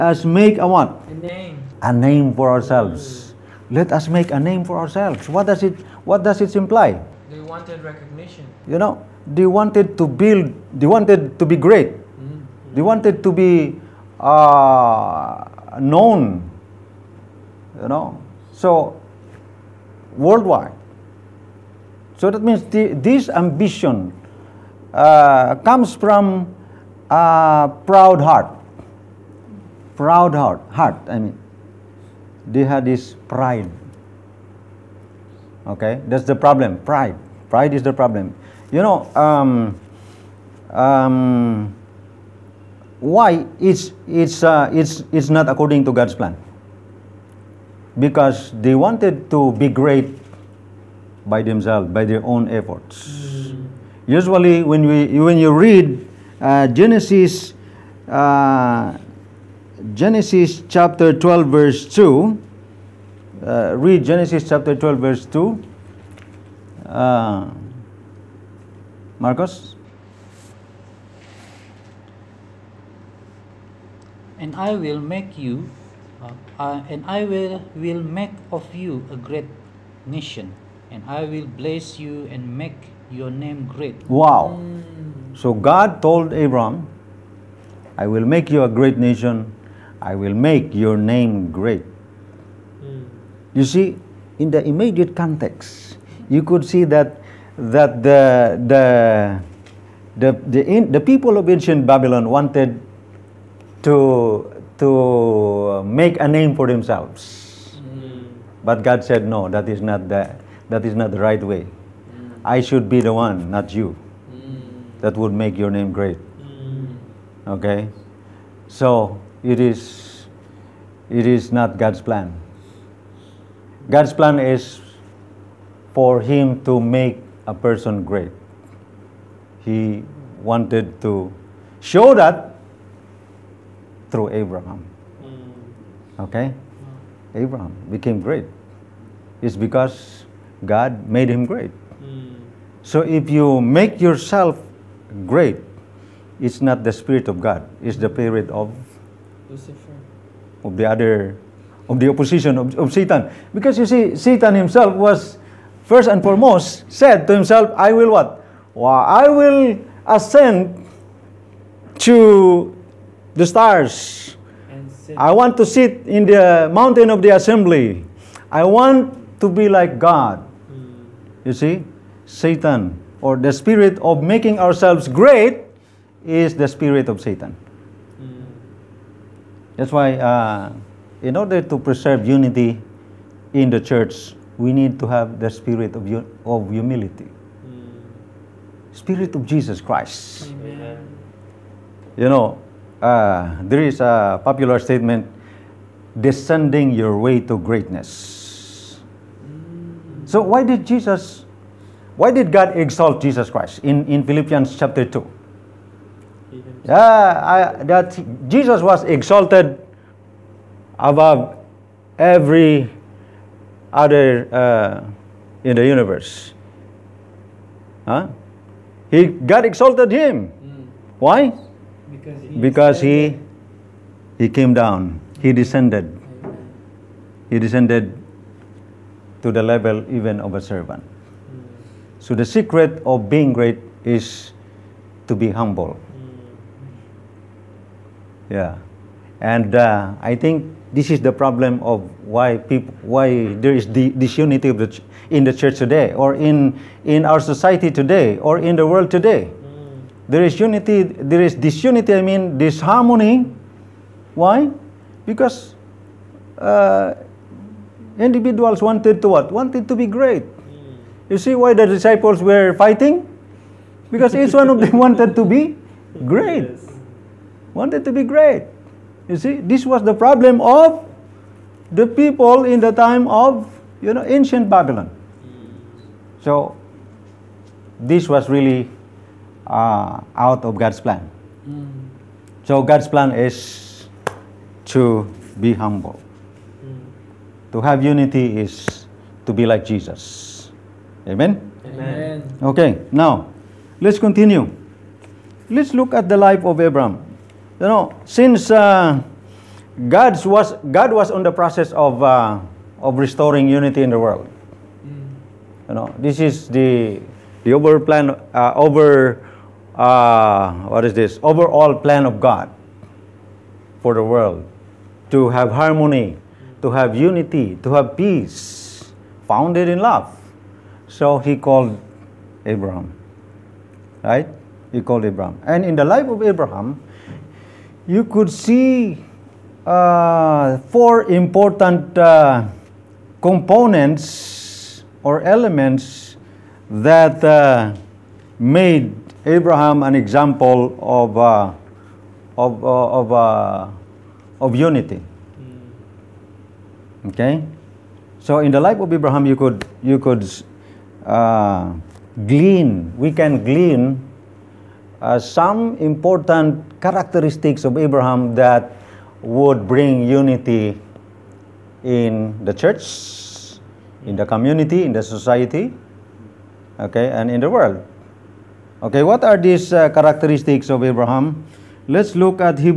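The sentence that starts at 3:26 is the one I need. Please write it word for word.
Yeah, I, that Jesus was exalted above every other uh, in the universe.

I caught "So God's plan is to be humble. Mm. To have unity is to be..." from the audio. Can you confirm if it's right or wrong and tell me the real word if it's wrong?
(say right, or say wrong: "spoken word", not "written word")
right.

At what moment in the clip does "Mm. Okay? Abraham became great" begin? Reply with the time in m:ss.
2:15.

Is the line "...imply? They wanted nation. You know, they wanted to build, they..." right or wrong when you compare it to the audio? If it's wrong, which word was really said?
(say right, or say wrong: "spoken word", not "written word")
wrong: "recognition", not "nation".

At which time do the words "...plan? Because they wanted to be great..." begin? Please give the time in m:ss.
0:46.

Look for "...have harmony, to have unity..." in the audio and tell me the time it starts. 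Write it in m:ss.
5:15.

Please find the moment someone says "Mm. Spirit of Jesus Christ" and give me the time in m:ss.
3:07.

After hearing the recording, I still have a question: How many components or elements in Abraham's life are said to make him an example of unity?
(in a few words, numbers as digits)
4.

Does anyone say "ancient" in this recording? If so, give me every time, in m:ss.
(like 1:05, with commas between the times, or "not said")
1:41, 4:34.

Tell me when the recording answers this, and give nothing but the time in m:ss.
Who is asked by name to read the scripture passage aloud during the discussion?
1:09.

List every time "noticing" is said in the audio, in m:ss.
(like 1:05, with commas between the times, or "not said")
not said.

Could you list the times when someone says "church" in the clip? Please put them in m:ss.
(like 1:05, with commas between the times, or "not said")
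3:03, 4:05, 6:02.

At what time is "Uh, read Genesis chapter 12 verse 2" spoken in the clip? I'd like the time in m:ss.
1:03.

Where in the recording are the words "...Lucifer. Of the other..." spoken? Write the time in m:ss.
2:29.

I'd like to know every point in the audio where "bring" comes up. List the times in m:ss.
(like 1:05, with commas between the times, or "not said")
5:59.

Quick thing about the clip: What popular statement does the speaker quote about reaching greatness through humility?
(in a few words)
descending your way to greatness.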